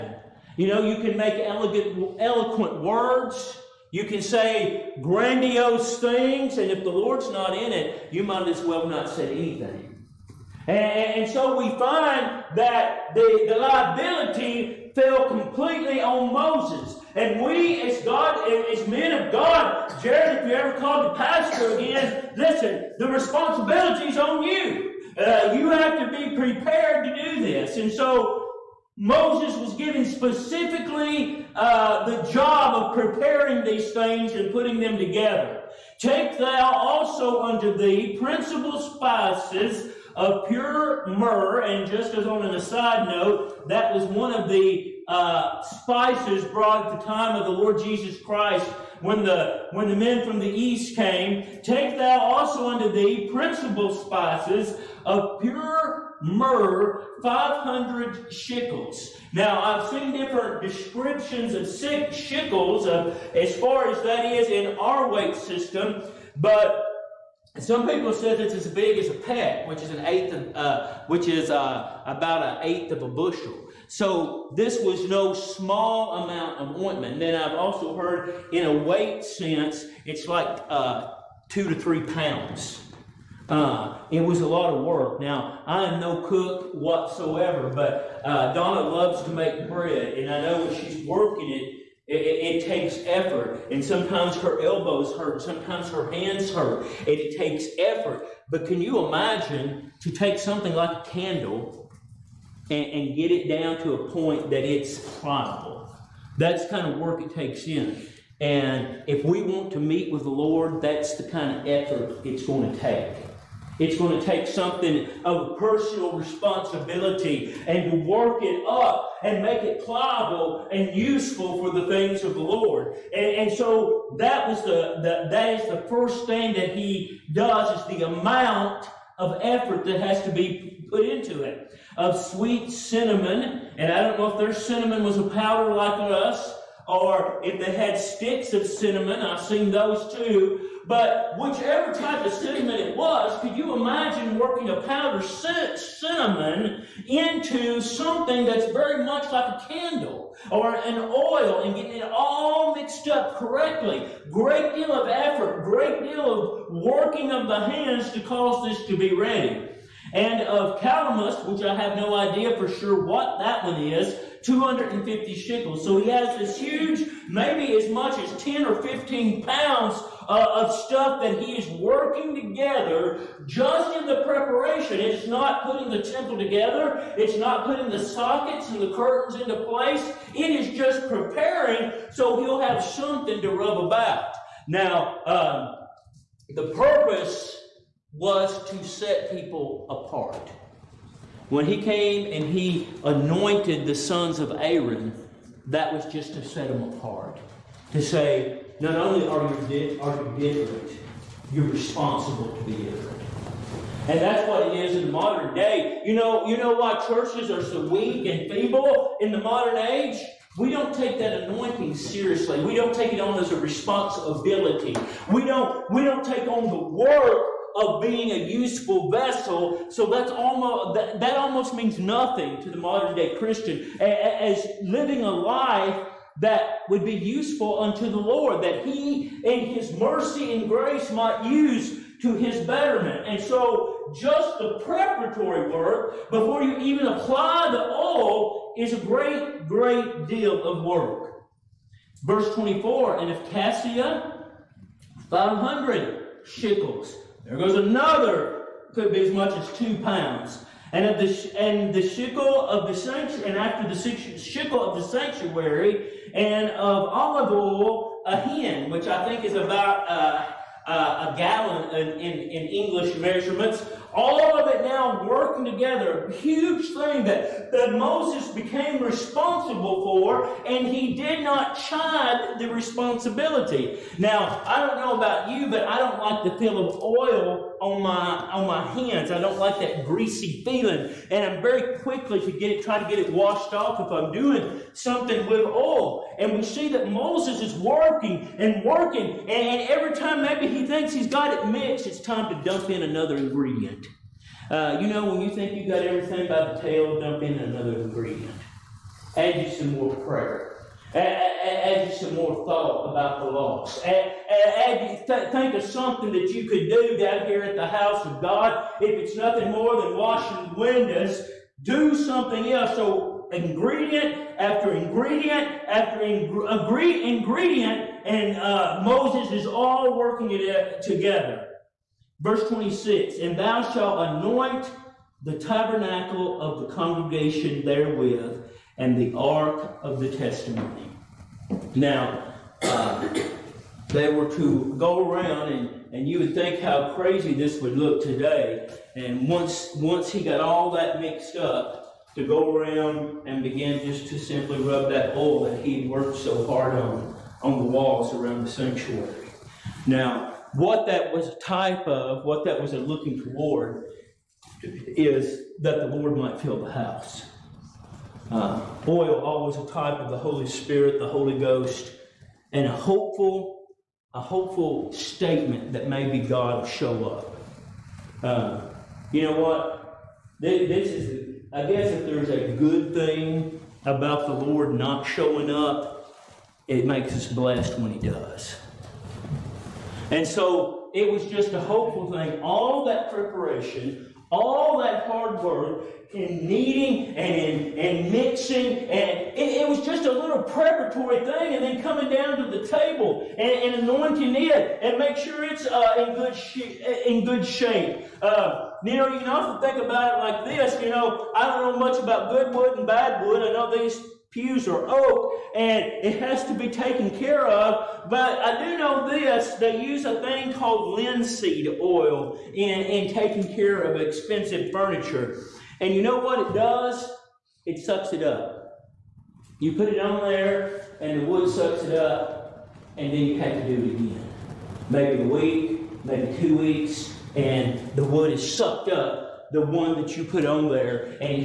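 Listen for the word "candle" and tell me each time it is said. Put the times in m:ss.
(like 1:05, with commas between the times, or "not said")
1:41, 2:29.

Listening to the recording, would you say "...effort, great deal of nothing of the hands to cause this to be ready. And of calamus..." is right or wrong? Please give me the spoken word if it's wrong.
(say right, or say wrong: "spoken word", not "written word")
wrong: "working", not "nothing".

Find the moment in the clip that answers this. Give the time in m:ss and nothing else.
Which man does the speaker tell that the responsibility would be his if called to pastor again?
0:20.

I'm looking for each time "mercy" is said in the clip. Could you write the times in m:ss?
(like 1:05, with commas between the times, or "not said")
3:49.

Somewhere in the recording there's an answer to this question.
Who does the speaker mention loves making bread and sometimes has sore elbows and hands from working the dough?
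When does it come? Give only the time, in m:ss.
1:28.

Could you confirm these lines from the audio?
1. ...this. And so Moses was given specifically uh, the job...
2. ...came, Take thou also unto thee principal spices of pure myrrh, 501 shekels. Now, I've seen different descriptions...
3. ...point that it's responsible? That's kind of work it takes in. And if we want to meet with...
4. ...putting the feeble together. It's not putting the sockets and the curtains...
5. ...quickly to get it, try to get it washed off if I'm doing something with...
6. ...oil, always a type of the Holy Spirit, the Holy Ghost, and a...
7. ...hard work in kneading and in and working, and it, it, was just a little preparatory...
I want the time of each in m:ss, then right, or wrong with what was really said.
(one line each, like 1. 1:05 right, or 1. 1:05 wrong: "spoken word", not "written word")
1. 0:27 right
2. 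0:50 wrong: "500", not "501"
3. 1:44 wrong: "pliable", not "responsible"
4. 2:55 wrong: "temple", not "feeble"
5. 4:41 right
6. 5:59 right
7. 6:25 wrong: "mixing", not "working".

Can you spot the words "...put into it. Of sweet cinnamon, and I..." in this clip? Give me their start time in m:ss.
2:10.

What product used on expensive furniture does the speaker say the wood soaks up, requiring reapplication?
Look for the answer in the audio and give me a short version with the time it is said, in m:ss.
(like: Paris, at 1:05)
linseed oil, at 6:51.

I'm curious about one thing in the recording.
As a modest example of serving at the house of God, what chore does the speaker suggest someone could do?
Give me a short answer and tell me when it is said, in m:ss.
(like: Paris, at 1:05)
washing windows, at 5:10.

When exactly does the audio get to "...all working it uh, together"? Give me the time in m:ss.
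5:19.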